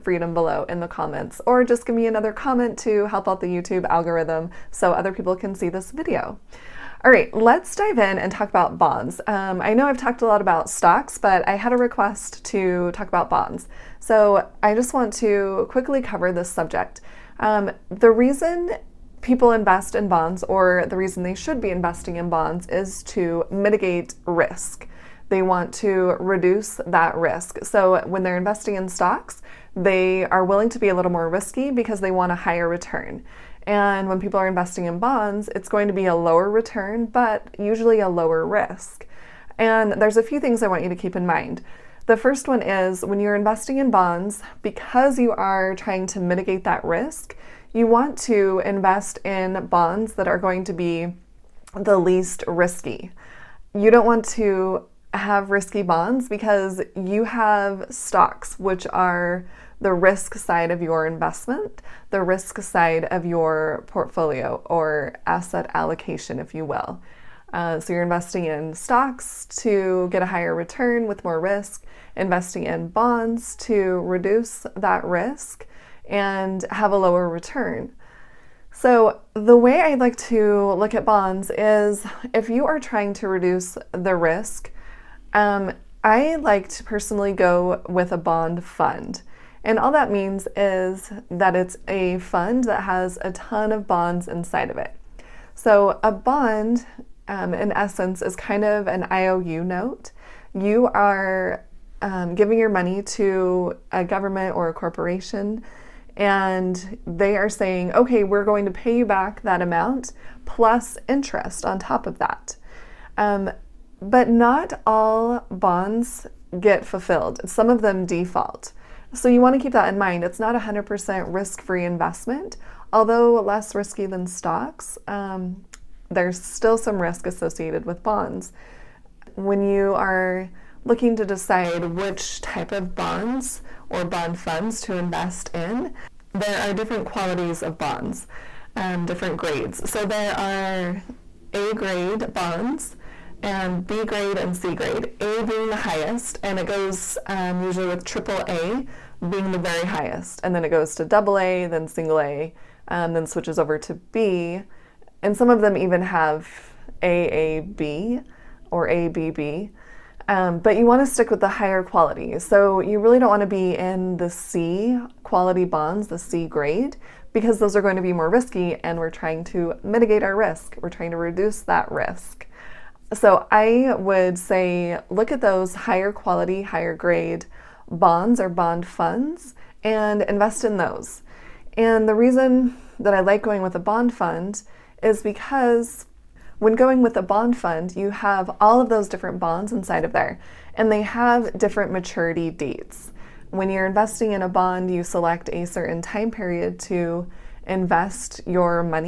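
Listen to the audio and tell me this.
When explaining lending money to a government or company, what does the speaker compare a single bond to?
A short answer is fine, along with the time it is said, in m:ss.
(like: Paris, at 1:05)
IOU note, at 1:39.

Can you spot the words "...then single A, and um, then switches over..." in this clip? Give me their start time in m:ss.
2:31.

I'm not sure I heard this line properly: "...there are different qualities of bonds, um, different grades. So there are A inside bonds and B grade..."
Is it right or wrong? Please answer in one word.
wrong.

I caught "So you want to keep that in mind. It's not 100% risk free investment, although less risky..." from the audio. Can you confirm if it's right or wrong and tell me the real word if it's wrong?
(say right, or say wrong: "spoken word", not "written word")
right.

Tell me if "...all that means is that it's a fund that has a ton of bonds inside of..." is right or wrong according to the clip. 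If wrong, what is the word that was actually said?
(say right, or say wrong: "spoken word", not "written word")
right.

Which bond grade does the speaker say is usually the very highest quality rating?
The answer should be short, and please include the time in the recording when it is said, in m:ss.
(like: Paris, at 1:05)
triple A, at 2:28.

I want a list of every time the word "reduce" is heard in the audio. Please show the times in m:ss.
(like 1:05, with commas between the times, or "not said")
0:26, 1:14, 1:23, 2:51.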